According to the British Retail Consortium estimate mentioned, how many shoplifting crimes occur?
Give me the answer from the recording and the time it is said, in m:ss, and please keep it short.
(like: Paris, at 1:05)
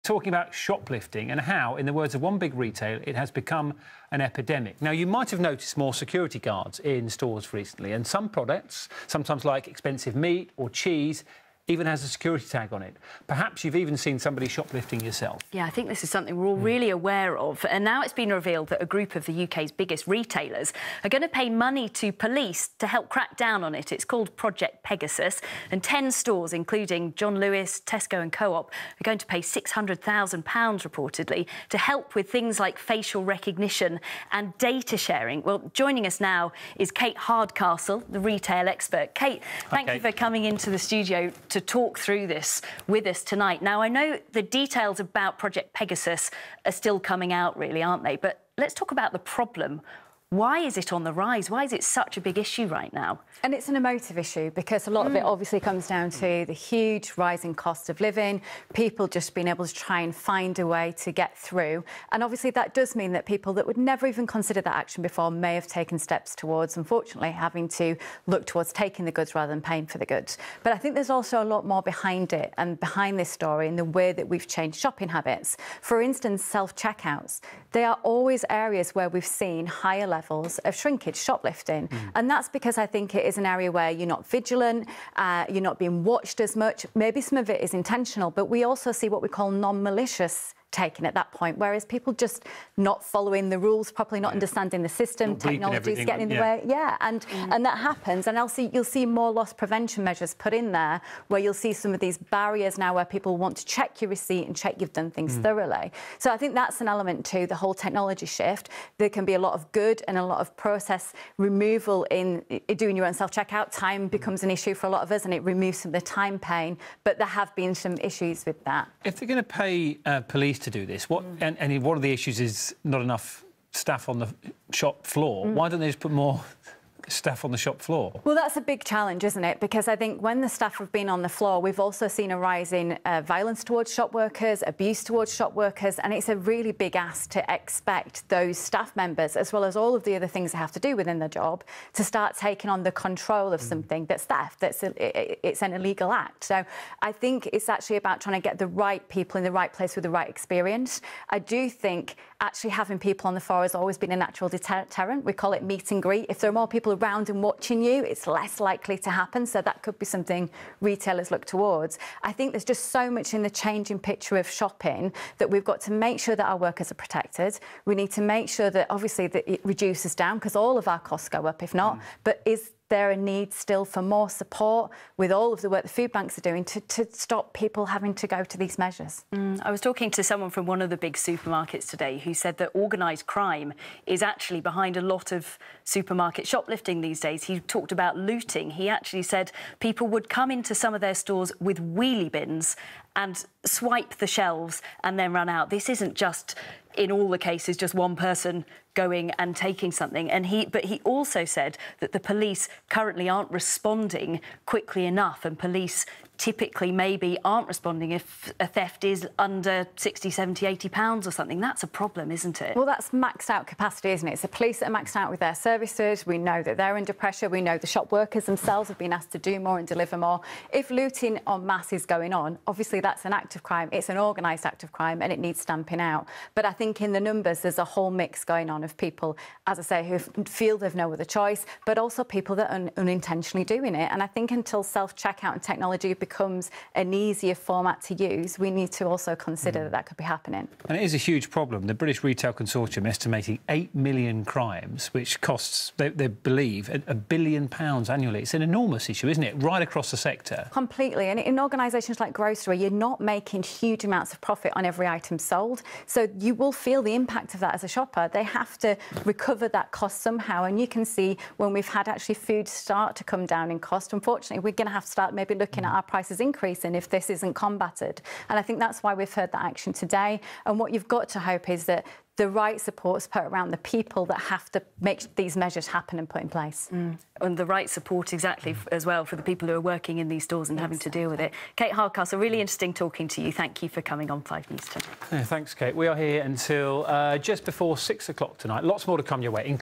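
8 million, at 4:03.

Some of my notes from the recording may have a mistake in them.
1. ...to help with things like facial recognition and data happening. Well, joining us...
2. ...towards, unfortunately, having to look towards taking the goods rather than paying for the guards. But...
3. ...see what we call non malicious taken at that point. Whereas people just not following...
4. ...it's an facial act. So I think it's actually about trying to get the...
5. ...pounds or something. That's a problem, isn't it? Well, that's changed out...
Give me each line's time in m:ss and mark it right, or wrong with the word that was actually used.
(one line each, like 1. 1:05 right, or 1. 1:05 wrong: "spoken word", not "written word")
1. 0:31 wrong: "sharing", not "happening"
2. 1:06 wrong: "goods", not "guards"
3. 1:28 right
4. 2:25 wrong: "illegal", not "facial"
5. 3:30 wrong: "maxed", not "changed".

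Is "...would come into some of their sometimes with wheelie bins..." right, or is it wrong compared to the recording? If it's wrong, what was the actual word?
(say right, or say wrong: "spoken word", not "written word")
wrong: "stores", not "sometimes".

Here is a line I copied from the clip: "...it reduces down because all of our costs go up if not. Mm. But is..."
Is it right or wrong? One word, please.
right.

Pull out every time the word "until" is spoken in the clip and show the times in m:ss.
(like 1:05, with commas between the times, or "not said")
3:54, 4:46.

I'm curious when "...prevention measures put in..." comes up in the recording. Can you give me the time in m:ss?
1:39.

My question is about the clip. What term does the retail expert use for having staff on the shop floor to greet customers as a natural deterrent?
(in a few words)
meet and greet.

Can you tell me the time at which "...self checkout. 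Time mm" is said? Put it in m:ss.
1:53.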